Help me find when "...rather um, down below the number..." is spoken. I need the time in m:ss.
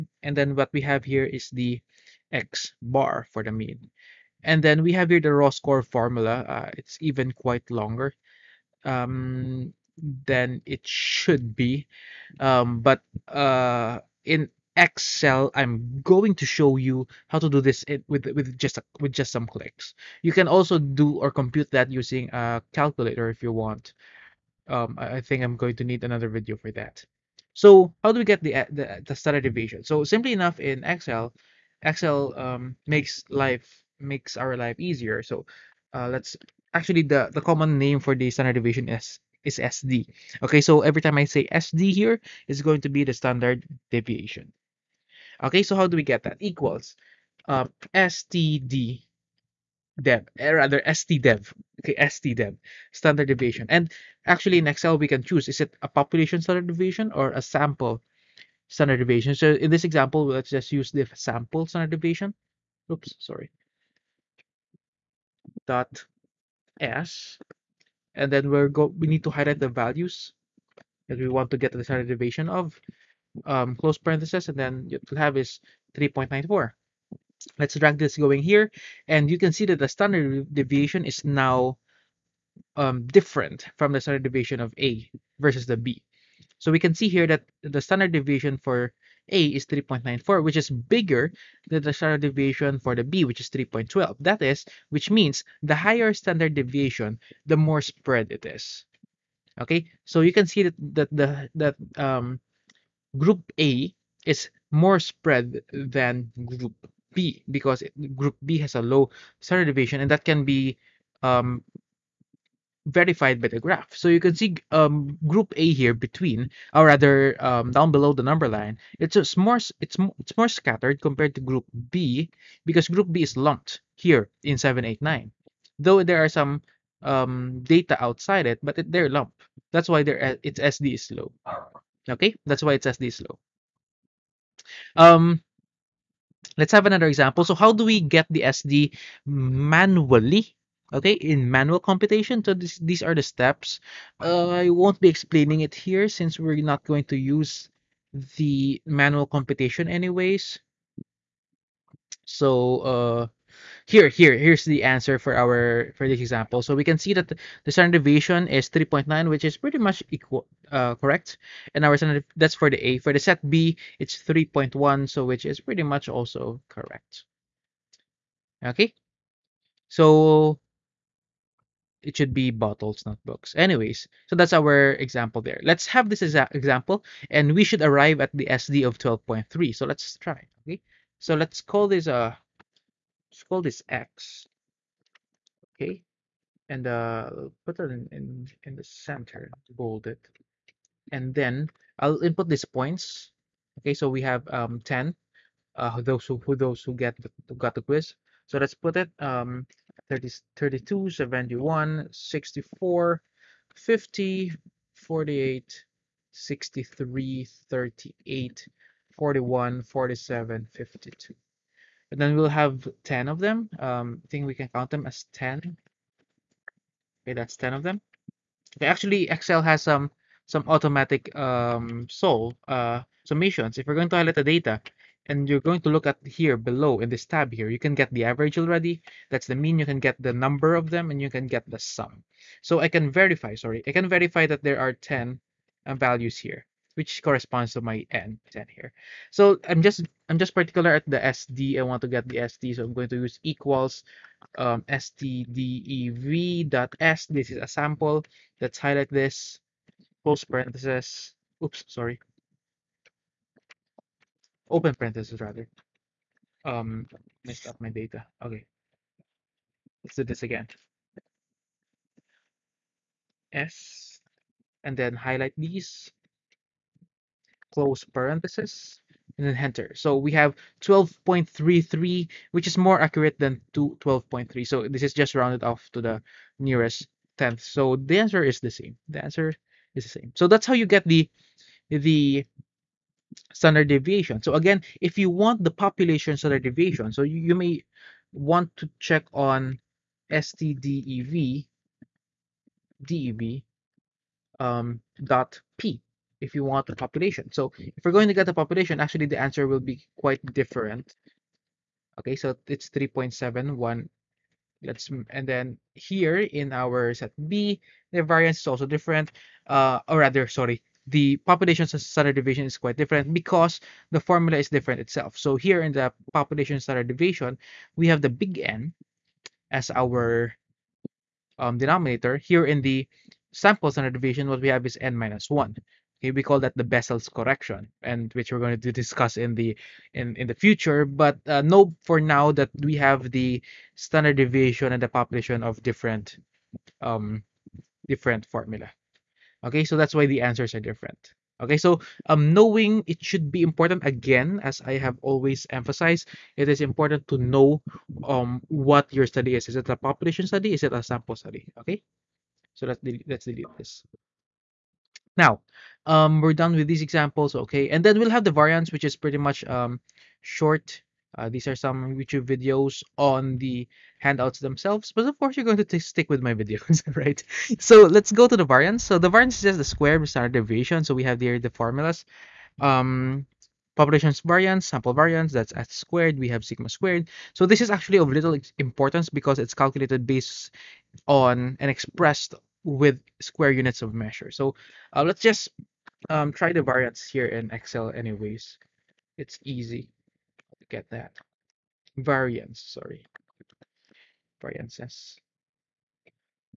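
1:56.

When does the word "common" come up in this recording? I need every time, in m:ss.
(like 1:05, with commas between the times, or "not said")
0:37.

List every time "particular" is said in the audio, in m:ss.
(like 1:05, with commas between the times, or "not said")
4:00.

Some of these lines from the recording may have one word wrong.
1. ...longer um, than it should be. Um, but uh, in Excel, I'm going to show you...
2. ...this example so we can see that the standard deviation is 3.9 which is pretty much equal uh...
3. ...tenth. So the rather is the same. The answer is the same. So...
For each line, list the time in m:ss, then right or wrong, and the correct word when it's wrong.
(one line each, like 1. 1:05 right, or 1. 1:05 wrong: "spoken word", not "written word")
1. 0:07 right
2. 2:36 right
3. 4:37 wrong: "answer", not "rather".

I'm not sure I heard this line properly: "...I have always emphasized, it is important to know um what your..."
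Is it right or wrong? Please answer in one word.
right.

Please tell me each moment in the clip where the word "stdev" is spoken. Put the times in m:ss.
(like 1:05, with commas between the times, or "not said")
4:04, 4:50.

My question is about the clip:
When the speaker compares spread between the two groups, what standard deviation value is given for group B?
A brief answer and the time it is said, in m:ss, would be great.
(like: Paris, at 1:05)
3.12, at 1:33.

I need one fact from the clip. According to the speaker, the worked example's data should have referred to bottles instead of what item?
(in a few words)
books.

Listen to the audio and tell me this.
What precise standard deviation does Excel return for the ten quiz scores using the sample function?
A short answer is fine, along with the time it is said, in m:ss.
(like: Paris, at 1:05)
12.33, at 4:30.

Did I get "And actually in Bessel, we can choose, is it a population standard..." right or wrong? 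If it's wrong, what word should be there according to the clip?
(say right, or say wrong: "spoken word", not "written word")
wrong: "Excel", not "Bessel".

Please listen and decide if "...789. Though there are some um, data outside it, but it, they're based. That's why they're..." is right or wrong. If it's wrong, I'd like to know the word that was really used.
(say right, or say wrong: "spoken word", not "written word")
wrong: "lumped", not "based".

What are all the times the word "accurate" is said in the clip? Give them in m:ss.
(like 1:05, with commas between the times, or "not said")
4:33.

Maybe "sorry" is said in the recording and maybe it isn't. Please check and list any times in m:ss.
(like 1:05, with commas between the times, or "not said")
1:03, 3:53, 4:11, 5:10, 6:32.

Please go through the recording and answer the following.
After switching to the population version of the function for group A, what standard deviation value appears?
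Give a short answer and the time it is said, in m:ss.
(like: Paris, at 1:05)
3.71, at 5:02.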